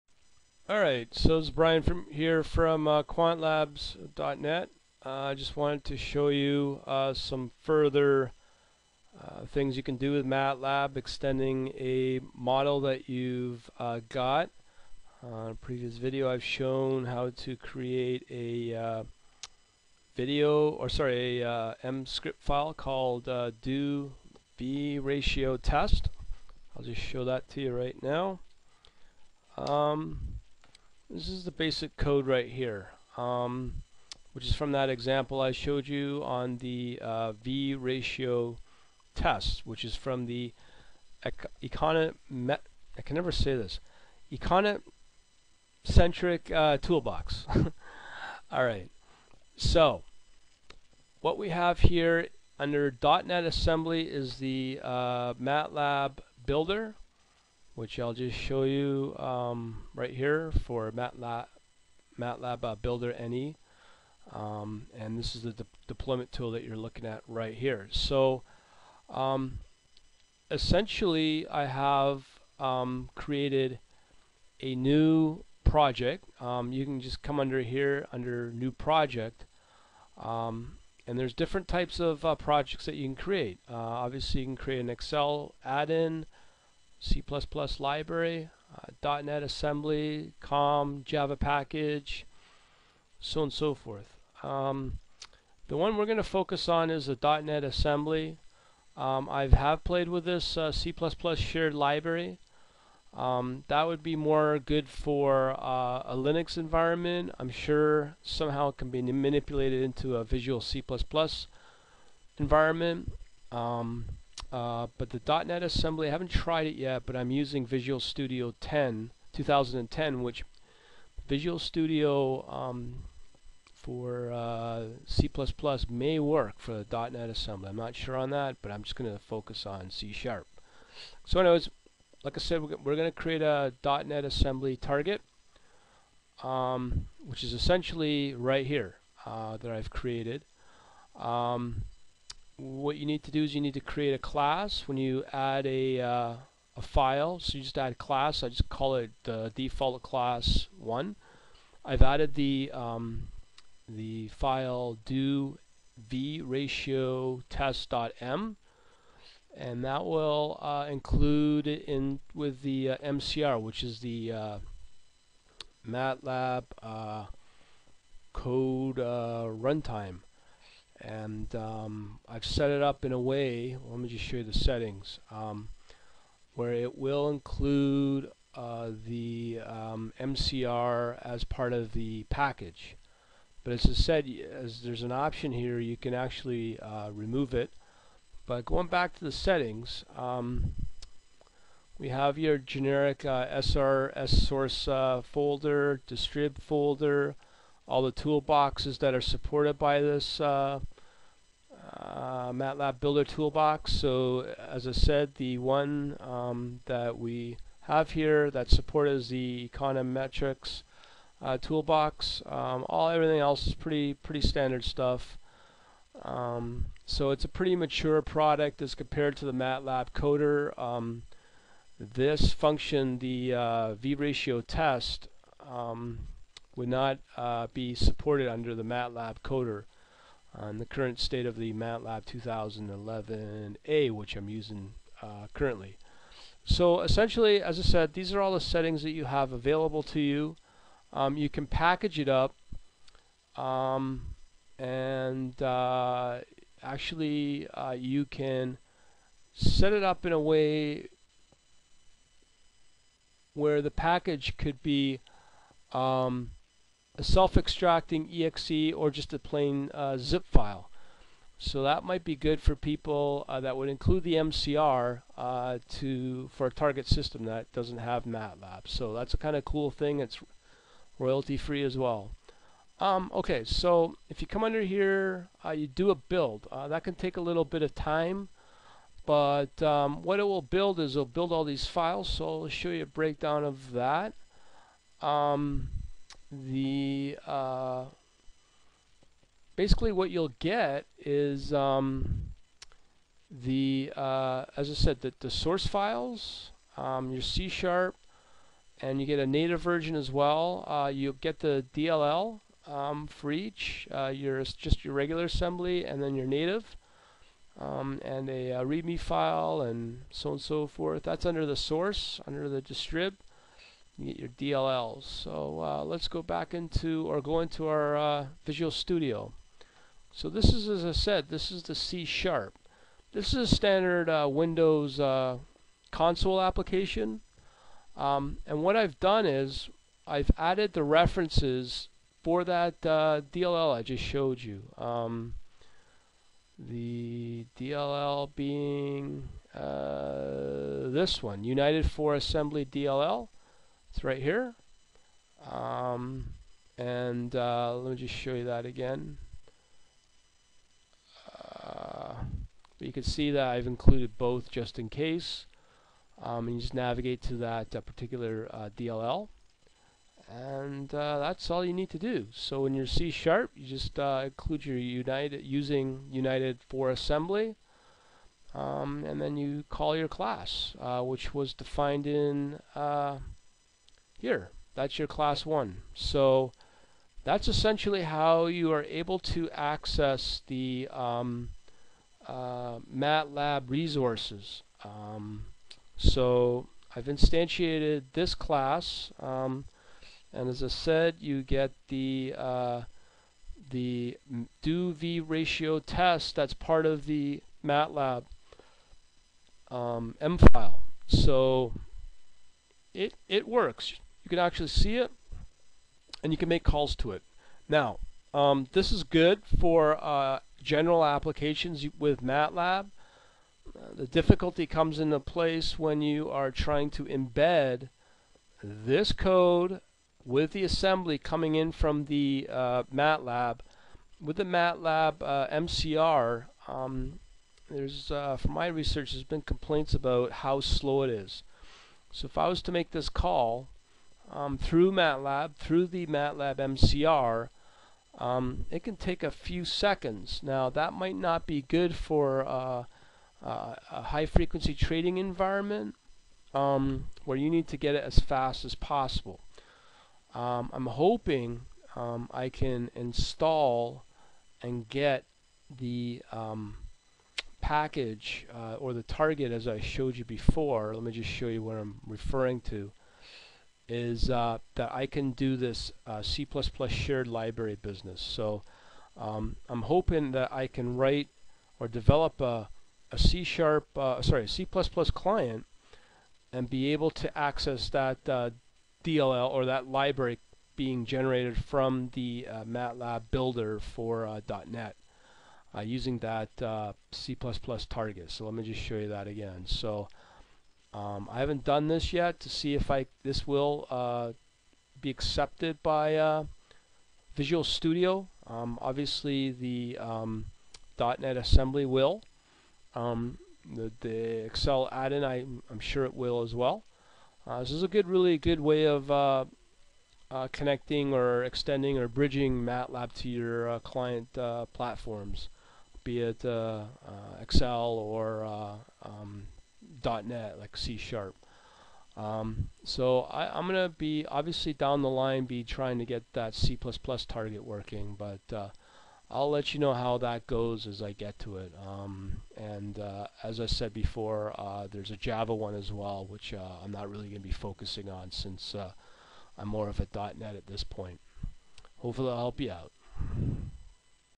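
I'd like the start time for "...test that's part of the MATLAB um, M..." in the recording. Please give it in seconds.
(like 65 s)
395 s.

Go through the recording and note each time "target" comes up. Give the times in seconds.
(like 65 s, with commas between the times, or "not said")
134 s, 266 s, 459 s, 488 s, 527 s.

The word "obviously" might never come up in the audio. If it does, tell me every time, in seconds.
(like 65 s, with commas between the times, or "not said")
83 s, 499 s, 524 s.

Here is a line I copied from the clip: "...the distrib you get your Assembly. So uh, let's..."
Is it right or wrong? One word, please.
wrong.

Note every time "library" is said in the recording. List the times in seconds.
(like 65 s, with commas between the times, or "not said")
87 s, 101 s, 467 s, 480 s.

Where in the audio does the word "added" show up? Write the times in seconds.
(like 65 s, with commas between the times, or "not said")
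152 s, 330 s.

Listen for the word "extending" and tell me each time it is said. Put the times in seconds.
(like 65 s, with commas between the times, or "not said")
10 s, 511 s.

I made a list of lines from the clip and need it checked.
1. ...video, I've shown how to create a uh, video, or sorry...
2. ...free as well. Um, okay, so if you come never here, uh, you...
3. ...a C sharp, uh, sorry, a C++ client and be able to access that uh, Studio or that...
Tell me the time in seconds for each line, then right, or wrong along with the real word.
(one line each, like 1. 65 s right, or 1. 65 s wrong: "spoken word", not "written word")
1. 15 s right
2. 271 s wrong: "under", not "never"
3. 473 s wrong: "DLL", not "Studio".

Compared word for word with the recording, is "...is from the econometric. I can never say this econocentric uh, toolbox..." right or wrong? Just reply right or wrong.
right.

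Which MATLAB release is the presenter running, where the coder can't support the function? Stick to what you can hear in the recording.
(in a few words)
MATLAB 2011A.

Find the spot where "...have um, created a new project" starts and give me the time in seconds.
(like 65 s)
71 s.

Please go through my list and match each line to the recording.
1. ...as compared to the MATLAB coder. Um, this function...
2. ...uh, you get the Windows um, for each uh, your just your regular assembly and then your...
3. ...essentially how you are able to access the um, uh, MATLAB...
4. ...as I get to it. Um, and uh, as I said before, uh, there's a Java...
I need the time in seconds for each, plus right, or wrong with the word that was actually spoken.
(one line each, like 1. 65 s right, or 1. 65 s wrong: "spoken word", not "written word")
1. 218 s right
2. 300 s wrong: "DLL", not "Windows"
3. 377 s right
4. 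531 s right.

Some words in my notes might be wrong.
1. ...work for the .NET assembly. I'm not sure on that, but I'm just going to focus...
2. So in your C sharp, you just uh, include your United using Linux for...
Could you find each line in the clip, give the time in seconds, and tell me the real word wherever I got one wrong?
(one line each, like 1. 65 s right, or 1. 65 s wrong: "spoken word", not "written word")
1. 126 s right
2. 362 s wrong: "United", not "Linux".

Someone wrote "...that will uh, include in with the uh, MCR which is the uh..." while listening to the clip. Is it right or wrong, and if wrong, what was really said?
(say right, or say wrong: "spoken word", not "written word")
right.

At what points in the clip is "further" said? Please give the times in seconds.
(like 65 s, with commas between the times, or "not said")
7 s.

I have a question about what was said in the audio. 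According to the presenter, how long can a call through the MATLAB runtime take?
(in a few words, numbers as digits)
a few seconds.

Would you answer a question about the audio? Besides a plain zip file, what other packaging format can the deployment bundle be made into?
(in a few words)
self-extracting exe.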